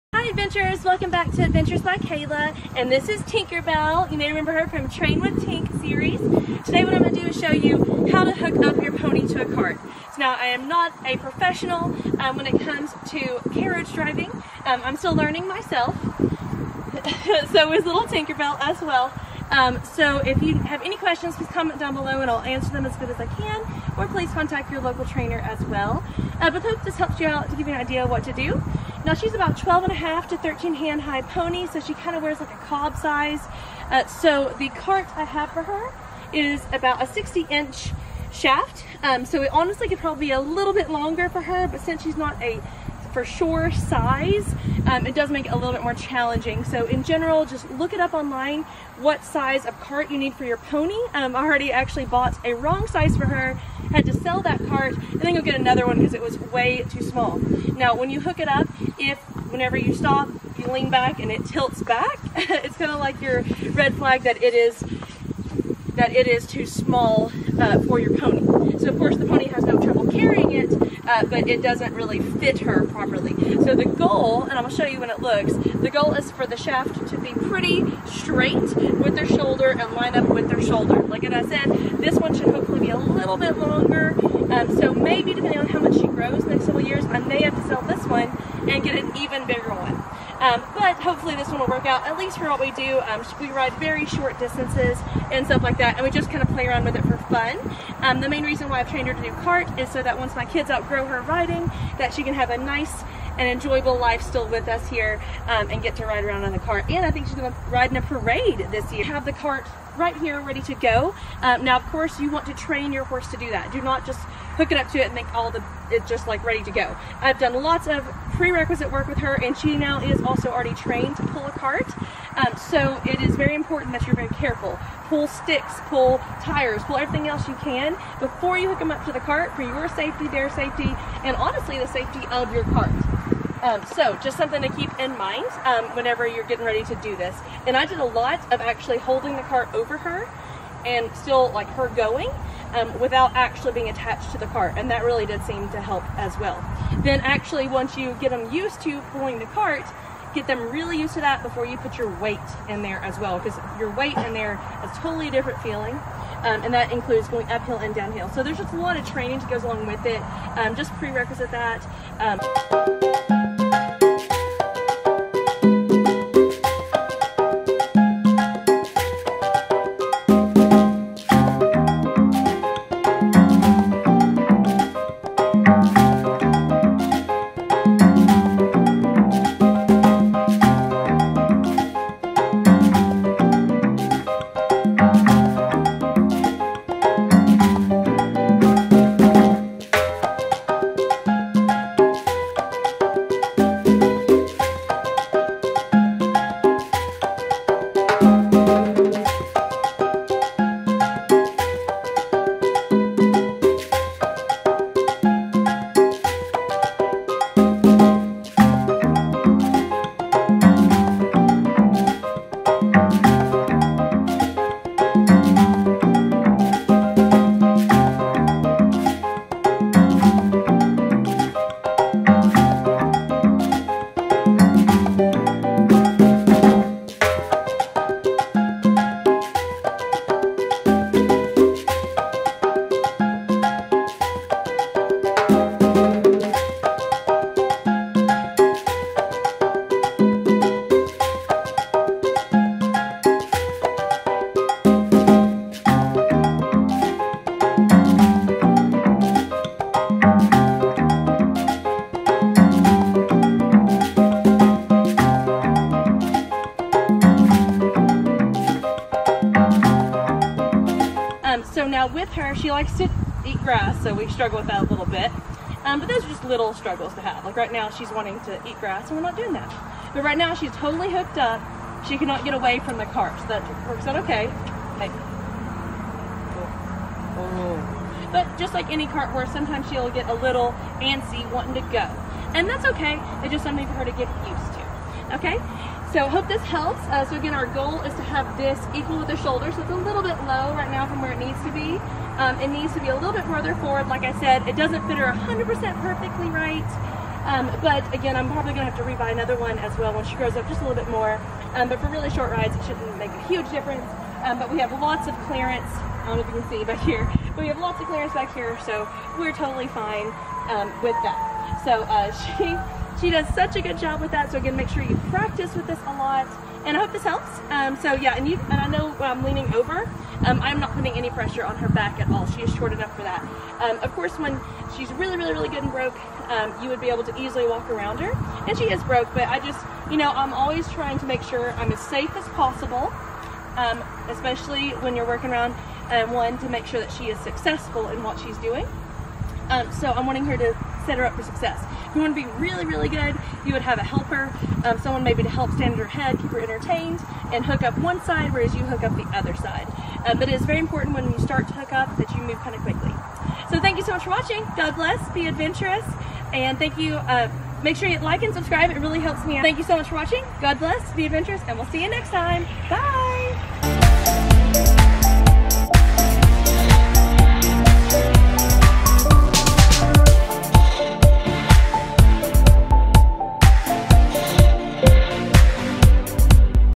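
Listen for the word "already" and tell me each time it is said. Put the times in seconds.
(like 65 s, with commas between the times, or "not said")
51 s, 120 s.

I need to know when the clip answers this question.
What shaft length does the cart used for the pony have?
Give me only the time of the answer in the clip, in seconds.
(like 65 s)
37 s.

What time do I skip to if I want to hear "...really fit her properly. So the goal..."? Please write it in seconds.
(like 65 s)
71 s.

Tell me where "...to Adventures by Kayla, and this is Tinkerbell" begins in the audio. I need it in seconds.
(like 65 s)
1 s.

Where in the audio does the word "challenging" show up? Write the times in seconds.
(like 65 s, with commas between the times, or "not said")
45 s.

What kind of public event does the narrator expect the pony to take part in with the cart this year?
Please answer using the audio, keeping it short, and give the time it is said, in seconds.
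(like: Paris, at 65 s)
a parade, at 108 s.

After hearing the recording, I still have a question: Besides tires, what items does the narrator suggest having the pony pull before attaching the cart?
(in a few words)
sticks.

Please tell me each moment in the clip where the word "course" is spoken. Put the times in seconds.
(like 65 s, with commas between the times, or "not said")
68 s, 111 s, 324 s.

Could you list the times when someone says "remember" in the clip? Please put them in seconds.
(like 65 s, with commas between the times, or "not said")
4 s.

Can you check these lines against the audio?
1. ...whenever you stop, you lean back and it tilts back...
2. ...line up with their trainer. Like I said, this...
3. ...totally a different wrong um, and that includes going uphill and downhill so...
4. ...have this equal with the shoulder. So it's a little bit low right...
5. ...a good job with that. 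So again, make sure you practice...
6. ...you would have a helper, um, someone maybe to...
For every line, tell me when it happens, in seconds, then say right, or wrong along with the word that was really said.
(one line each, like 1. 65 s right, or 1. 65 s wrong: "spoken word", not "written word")
1. 59 s right
2. 79 s wrong: "shoulder", not "trainer"
3. 154 s wrong: "feeling", not "wrong"
4. 288 s right
5. 313 s right
6. 343 s right.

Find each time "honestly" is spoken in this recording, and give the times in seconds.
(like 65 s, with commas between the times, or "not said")
39 s, 131 s.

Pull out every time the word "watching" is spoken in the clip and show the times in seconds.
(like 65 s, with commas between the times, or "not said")
354 s, 360 s.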